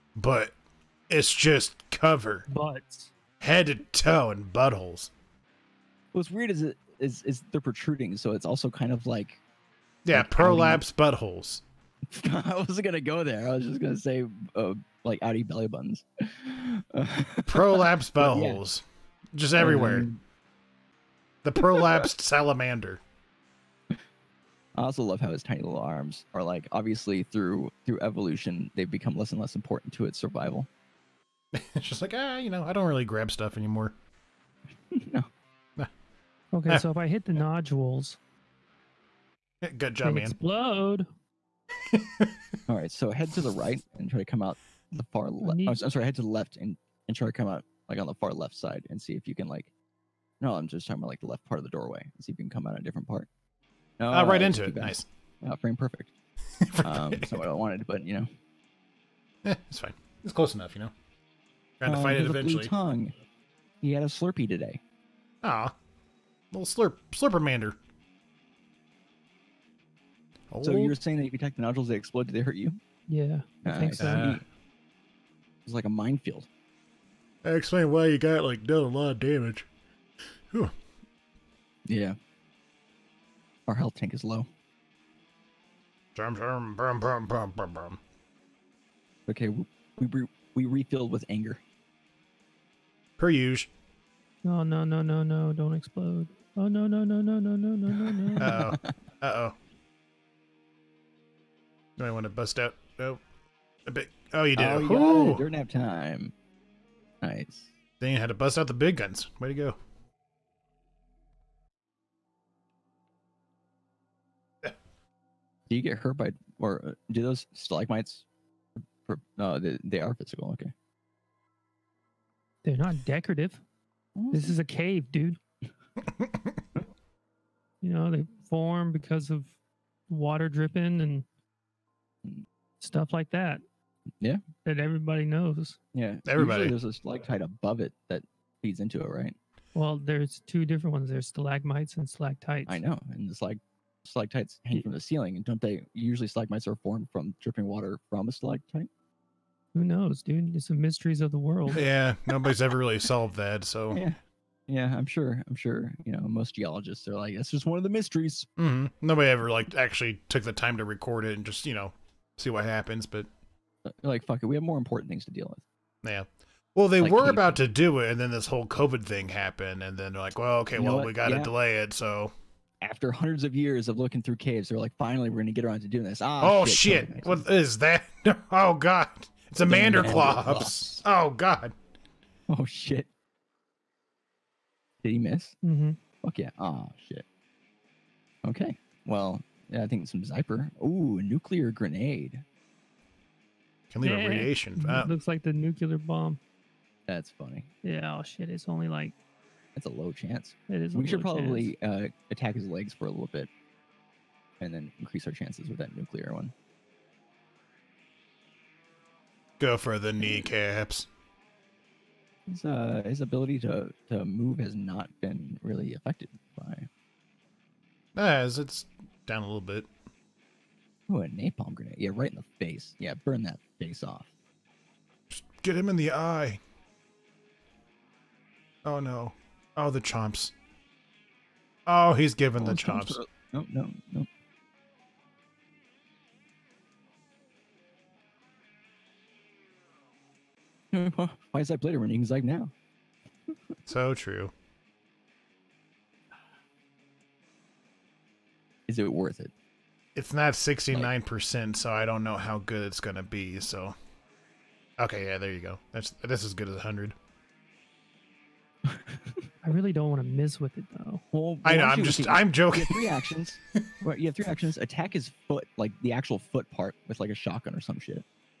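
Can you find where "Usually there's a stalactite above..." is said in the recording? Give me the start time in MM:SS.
02:16.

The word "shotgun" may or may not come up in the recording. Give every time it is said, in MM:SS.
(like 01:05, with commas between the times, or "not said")
04:27.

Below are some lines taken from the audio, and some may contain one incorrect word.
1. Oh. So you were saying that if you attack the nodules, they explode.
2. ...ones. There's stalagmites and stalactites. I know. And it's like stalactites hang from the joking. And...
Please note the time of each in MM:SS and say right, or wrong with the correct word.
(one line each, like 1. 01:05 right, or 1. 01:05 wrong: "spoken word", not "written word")
1. 01:10 right
2. 02:20 wrong: "ceiling", not "joking".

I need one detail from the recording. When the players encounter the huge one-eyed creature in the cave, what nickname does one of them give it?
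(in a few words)
Manderclops.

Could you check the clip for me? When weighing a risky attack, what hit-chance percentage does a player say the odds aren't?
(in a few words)
69%.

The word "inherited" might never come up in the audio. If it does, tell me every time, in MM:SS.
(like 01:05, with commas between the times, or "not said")
not said.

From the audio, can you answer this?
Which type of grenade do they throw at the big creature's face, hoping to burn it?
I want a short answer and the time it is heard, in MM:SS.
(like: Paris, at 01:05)
Napalm grenade, at 03:41.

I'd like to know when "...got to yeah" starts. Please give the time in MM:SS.
02:51.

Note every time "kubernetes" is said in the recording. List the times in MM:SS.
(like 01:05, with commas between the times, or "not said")
not said.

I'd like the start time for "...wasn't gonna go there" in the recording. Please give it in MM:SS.
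00:12.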